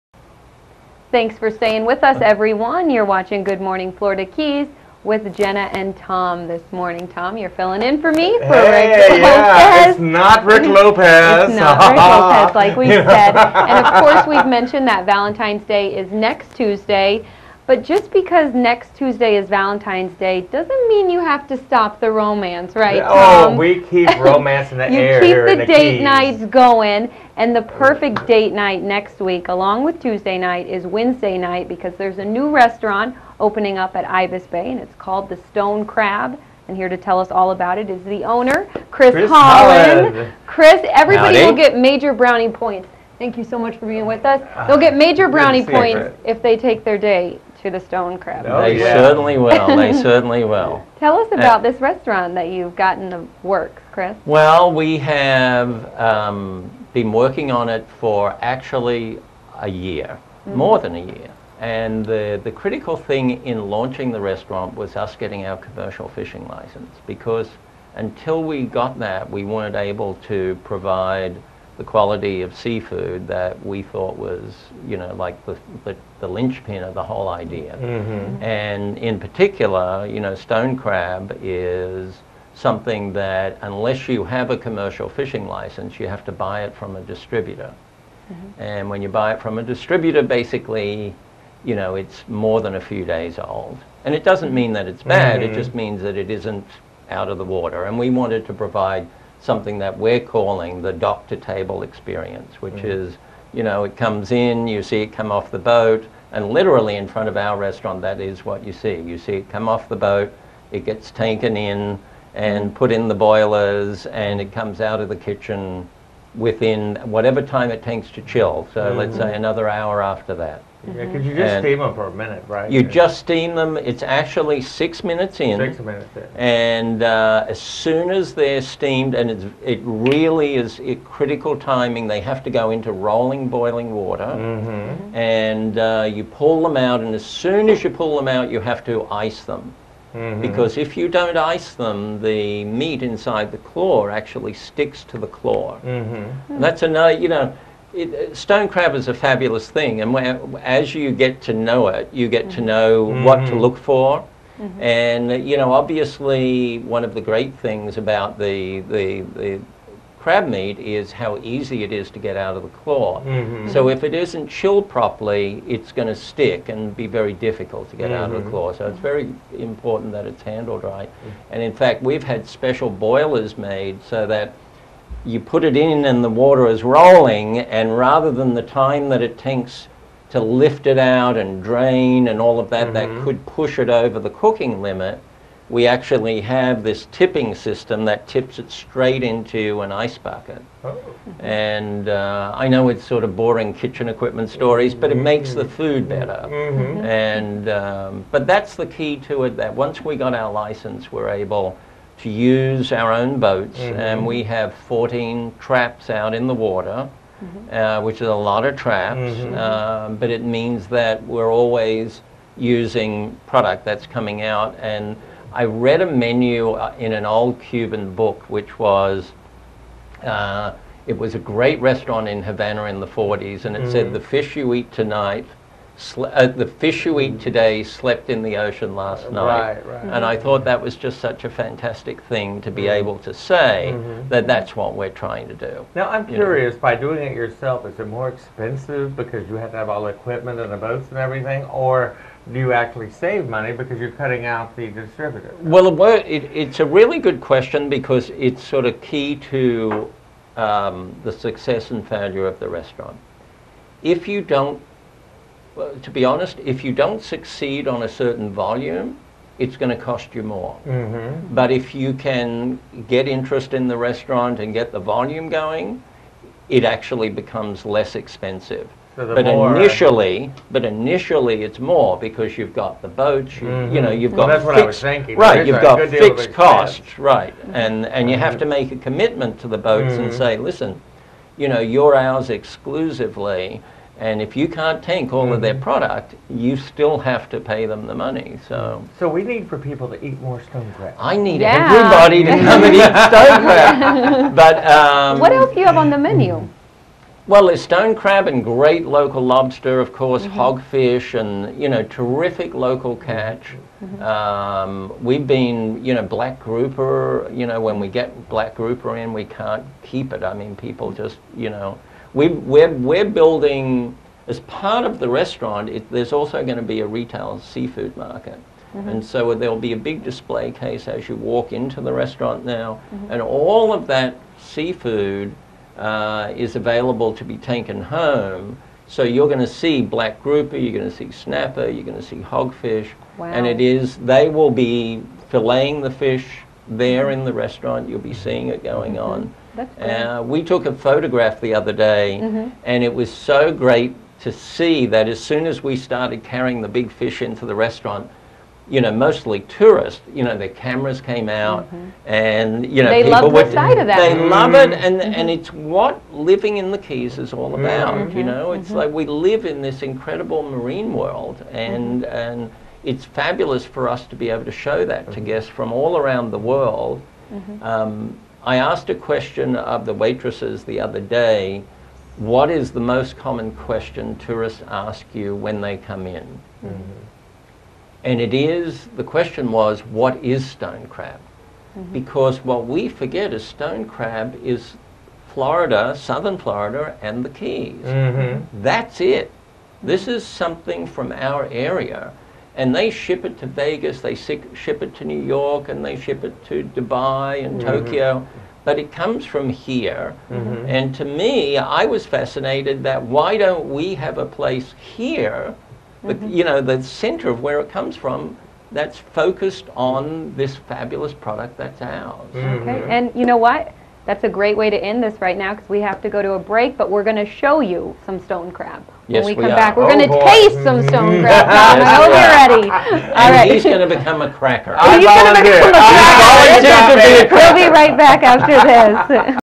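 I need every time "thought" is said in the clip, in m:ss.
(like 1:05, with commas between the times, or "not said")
1:13, 3:50.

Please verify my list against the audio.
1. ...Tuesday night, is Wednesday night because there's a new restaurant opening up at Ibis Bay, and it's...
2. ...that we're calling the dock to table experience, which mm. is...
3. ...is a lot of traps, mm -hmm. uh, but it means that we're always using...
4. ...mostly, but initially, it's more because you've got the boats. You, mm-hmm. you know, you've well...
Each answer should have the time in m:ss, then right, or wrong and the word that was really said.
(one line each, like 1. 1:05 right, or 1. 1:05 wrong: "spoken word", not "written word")
1. 0:30 right
2. 1:39 right
3. 3:28 right
4. 4:29 wrong: "initially", not "mostly".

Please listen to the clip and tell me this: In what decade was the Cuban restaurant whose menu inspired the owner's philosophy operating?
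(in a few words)
1940s.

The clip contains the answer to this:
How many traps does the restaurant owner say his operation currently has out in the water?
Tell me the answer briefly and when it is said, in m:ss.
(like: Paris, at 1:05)
14, at 3:24.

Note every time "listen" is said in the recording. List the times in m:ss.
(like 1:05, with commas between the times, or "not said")
4:40.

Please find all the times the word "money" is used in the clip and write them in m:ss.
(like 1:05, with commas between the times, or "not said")
4:03, 4:48.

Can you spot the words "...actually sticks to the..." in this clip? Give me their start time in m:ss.
2:24.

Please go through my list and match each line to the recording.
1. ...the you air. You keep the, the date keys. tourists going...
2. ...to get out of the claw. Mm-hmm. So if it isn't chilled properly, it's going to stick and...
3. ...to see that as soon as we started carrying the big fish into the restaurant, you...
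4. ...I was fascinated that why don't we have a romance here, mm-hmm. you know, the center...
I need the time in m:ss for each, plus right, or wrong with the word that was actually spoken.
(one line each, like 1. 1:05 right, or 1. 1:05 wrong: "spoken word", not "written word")
1. 0:24 wrong: "nights", not "tourists"
2. 2:42 right
3. 5:44 right
4. 6:41 wrong: "place", not "romance".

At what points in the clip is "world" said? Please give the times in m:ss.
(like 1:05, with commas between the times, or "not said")
6:01, 6:06.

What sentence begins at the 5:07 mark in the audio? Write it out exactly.
You know, when we get black grouper in, we can't keep it.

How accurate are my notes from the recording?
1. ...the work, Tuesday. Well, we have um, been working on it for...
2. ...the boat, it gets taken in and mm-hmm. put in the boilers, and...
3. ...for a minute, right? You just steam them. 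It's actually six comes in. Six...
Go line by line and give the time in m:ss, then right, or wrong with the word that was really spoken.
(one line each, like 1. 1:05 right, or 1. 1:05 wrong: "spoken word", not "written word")
1. 0:53 wrong: "Chris", not "Tuesday"
2. 1:49 right
3. 2:01 wrong: "minutes", not "comes".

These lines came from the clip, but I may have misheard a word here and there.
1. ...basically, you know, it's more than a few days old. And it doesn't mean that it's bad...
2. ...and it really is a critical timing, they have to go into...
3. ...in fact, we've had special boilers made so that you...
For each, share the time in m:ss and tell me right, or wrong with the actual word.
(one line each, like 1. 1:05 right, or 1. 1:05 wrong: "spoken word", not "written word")
1. 1:30 right
2. 2:09 right
3. 2:51 right.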